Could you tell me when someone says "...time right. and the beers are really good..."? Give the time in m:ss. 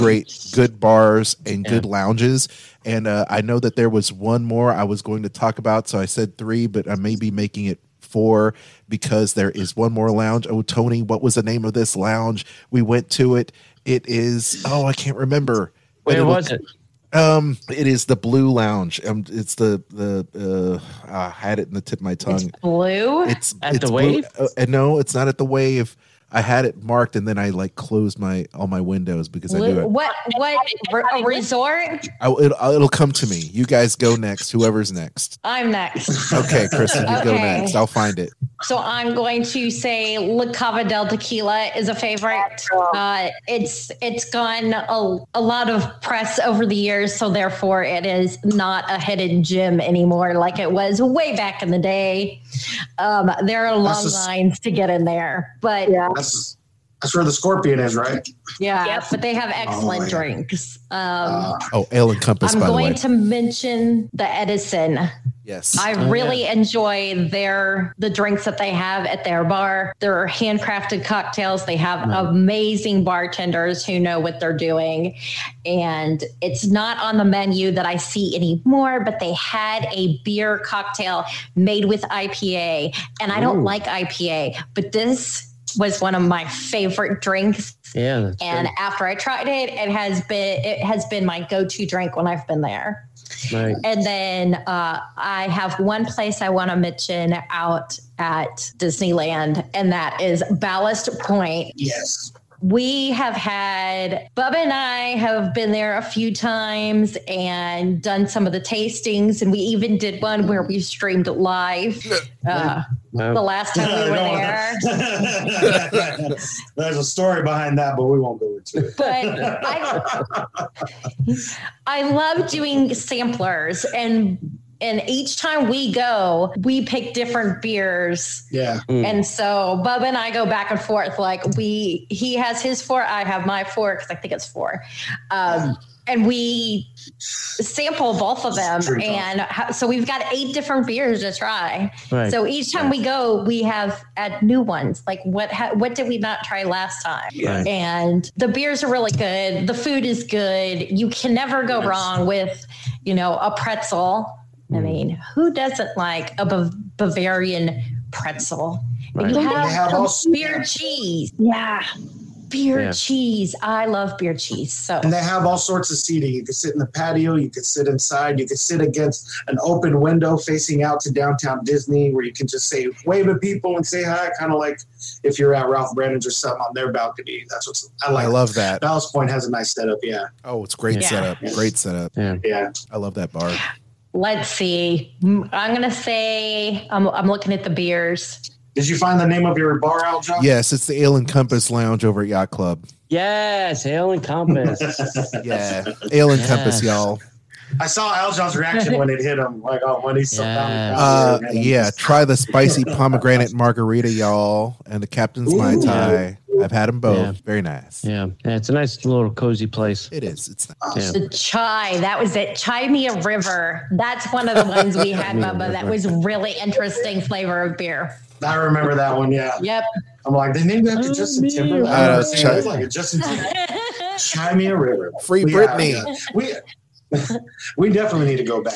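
2:27.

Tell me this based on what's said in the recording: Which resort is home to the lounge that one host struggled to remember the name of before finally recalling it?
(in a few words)
Yacht Club.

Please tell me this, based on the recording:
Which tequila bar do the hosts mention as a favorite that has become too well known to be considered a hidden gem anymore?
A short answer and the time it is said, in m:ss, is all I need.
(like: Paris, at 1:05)
La Cava del Tequila, at 0:40.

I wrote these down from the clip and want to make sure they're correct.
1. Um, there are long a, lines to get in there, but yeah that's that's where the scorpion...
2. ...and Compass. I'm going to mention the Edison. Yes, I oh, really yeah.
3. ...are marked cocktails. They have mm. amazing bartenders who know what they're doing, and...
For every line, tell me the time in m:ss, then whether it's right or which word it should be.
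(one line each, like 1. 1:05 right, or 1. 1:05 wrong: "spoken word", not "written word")
1. 0:52 right
2. 1:02 right
3. 1:10 wrong: "handcrafted", not "marked".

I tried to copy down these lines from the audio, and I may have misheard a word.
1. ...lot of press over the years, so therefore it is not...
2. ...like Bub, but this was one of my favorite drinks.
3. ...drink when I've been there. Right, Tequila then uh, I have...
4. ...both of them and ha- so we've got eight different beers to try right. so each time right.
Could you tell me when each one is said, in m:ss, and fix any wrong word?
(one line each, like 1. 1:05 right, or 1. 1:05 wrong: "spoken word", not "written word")
1. 0:45 right
2. 1:23 wrong: "IPA", not "Bub"
3. 1:31 wrong: "And", not "Tequila"
4. 2:18 right.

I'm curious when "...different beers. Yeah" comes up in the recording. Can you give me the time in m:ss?
2:07.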